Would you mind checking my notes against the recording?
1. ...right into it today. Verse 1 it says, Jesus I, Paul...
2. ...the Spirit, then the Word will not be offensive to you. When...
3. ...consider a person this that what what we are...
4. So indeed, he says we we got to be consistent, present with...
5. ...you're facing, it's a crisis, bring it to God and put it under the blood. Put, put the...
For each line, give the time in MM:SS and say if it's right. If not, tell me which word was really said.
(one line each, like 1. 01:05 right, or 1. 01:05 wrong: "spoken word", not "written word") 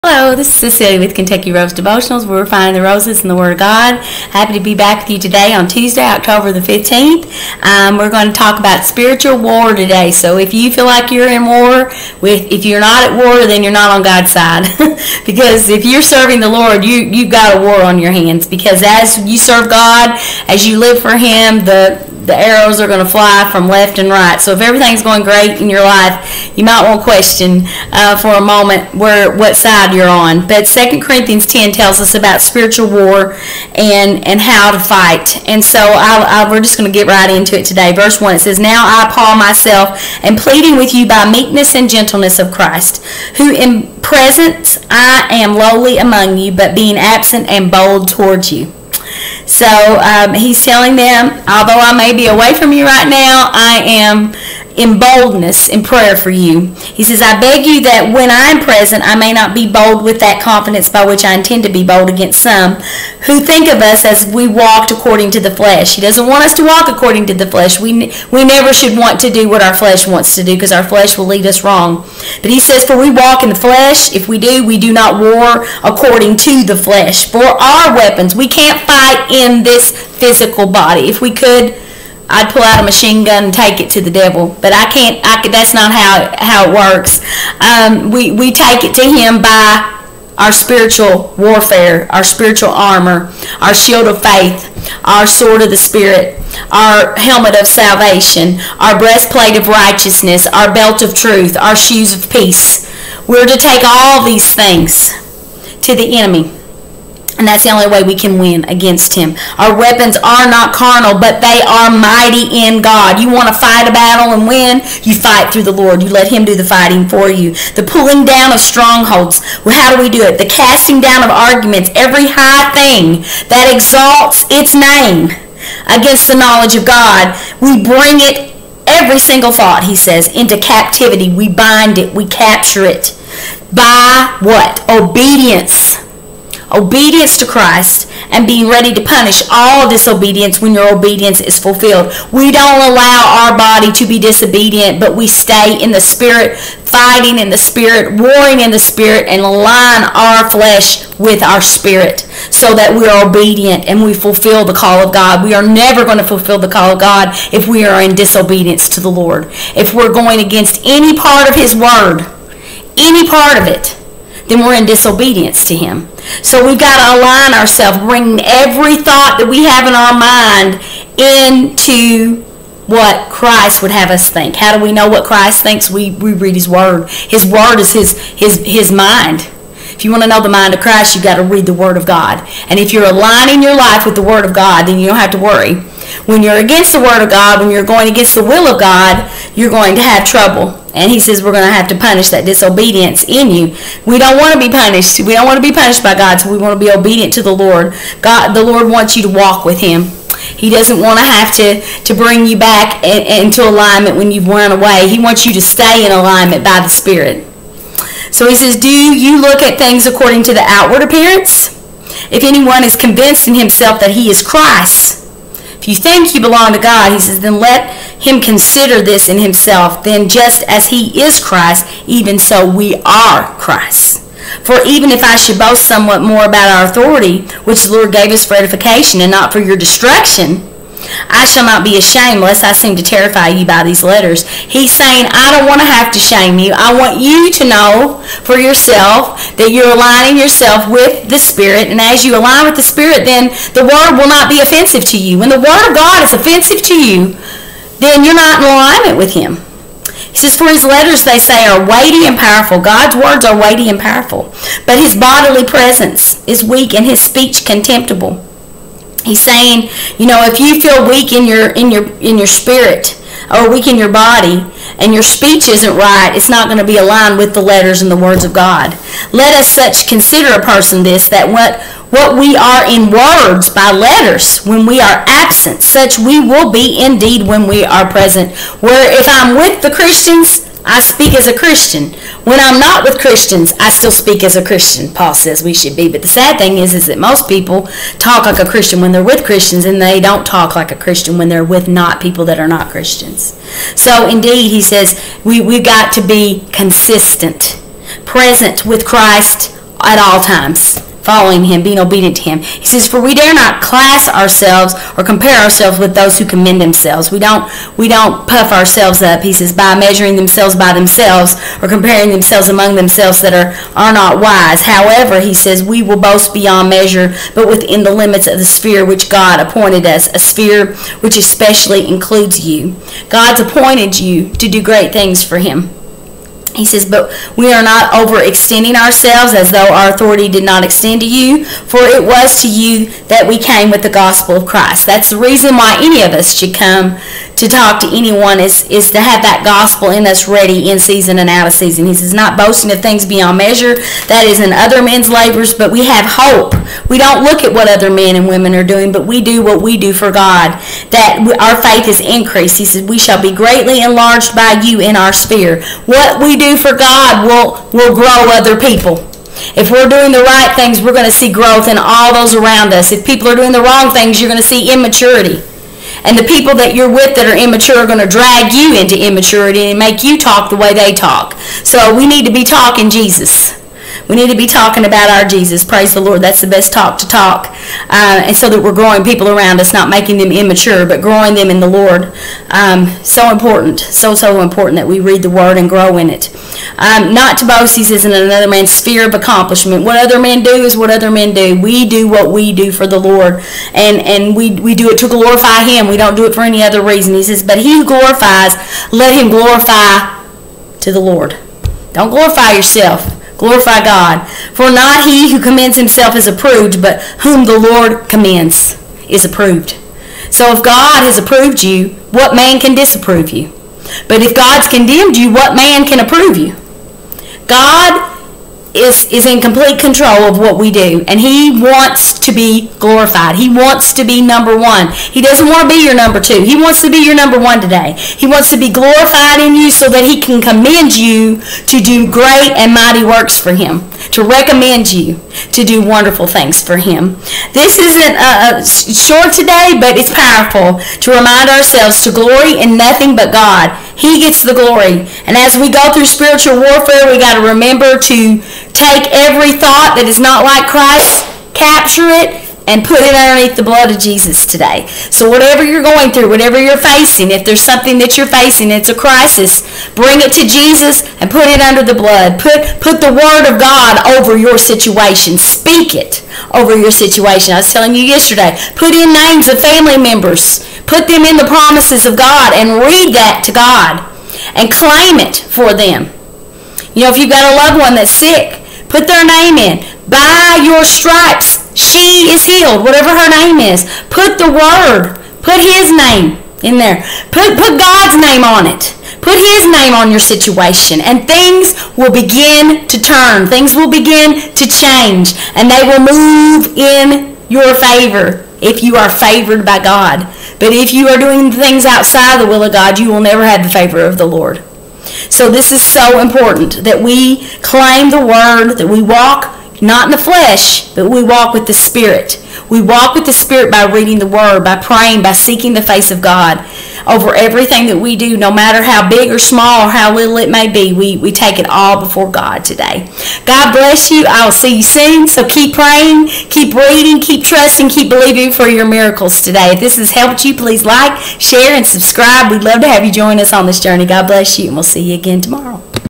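1. 00:37 wrong: "Now", not "Jesus"
2. 04:02 right
3. 04:30 right
4. 04:53 right
5. 07:38 wrong: "Jesus", not "God".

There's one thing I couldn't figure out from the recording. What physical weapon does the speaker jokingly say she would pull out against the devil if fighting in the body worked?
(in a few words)
machine gun.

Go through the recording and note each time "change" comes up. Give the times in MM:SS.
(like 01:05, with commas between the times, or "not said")
08:14.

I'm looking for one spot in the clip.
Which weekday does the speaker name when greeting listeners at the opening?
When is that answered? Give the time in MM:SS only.
00:05.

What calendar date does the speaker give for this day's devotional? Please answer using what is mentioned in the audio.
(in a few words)
October 15.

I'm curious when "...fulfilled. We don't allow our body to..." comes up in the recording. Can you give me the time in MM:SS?
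02:21.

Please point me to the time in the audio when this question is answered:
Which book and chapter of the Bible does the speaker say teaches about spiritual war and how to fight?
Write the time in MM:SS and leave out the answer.
00:30.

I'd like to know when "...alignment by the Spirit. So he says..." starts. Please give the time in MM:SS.
03:26.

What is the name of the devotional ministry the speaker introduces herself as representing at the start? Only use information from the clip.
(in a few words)
Kentucky Rose Devotionals.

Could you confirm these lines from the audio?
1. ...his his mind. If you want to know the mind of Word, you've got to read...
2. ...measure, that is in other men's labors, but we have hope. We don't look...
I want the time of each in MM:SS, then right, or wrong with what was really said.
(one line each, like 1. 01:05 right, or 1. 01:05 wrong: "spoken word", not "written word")
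1. 02:58 wrong: "Christ", not "Word"
2. 05:43 right.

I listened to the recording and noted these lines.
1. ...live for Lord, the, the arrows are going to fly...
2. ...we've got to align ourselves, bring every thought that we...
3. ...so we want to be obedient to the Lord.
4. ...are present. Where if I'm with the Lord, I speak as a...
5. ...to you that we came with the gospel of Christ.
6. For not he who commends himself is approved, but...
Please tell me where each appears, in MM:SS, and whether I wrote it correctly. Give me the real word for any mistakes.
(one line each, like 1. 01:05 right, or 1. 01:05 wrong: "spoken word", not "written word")
1. 00:20 wrong: "Him", not "Lord"
2. 02:46 right
3. 03:16 right
4. 04:37 wrong: "Christians", not "Lord"
5. 05:32 right
6. 06:44 right.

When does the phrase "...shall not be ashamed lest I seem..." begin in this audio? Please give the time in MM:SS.
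03:51.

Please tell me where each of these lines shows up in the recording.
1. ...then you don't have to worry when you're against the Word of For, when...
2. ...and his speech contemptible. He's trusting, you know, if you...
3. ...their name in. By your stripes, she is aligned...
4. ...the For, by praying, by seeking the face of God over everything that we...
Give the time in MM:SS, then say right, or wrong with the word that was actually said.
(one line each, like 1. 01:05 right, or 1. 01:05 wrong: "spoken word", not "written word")
1. 03:04 wrong: "God", not "For"
2. 04:16 wrong: "saying", not "trusting"
3. 07:59 wrong: "healed", not "aligned"
4. 08:34 wrong: "Word", not "For".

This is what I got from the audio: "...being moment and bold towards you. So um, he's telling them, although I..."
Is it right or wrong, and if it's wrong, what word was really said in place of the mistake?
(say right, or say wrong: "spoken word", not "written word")
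wrong: "absent", not "moment".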